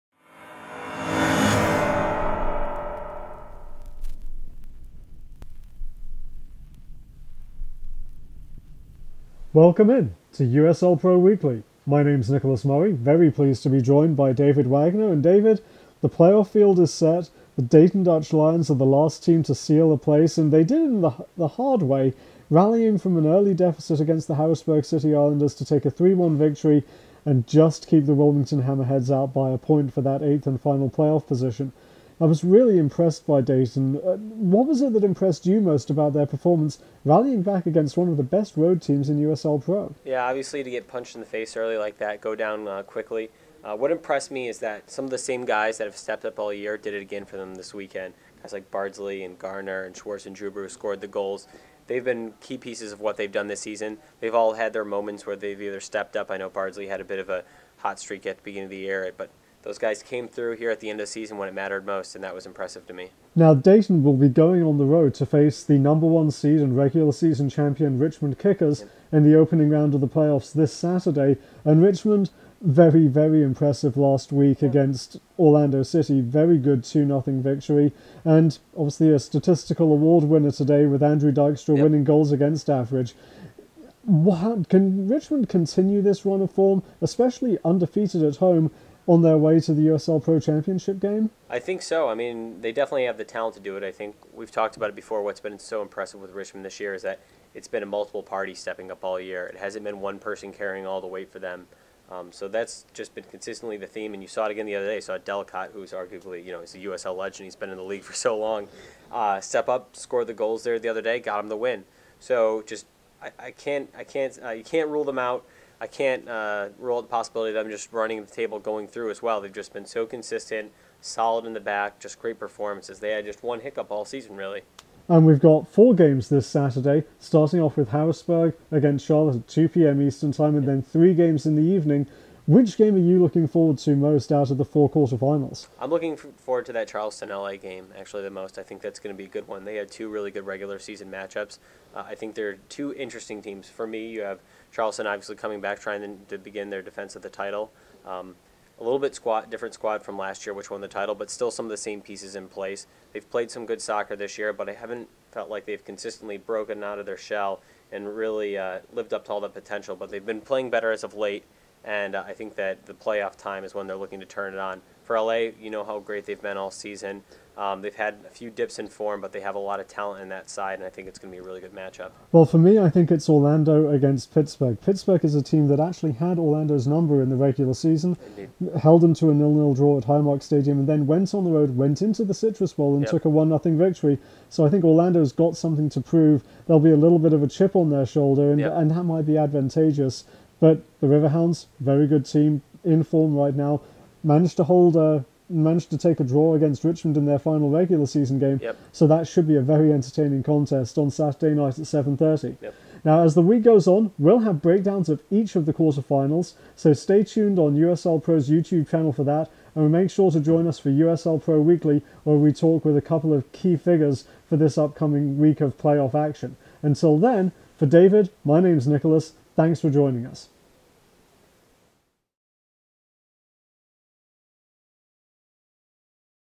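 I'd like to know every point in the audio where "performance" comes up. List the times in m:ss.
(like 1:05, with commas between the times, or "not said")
0:36, 2:02.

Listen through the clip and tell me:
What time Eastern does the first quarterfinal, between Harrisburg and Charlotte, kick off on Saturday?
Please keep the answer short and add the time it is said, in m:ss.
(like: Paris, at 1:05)
2 p.m., at 2:09.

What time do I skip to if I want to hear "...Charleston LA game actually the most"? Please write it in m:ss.
2:16.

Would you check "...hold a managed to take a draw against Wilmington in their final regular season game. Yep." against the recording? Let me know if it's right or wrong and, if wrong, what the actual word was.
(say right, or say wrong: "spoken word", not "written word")
wrong: "Richmond", not "Wilmington".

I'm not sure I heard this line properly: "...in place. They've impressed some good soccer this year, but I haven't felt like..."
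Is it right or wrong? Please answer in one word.
wrong.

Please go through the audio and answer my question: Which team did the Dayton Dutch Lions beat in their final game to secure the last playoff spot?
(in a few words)
Harrisburg City Islanders.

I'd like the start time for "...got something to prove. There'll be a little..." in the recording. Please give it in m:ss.
3:05.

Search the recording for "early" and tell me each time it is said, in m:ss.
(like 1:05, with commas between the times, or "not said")
0:23, 0:41.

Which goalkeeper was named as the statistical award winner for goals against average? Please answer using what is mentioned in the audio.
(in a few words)
Andrew Dykstra.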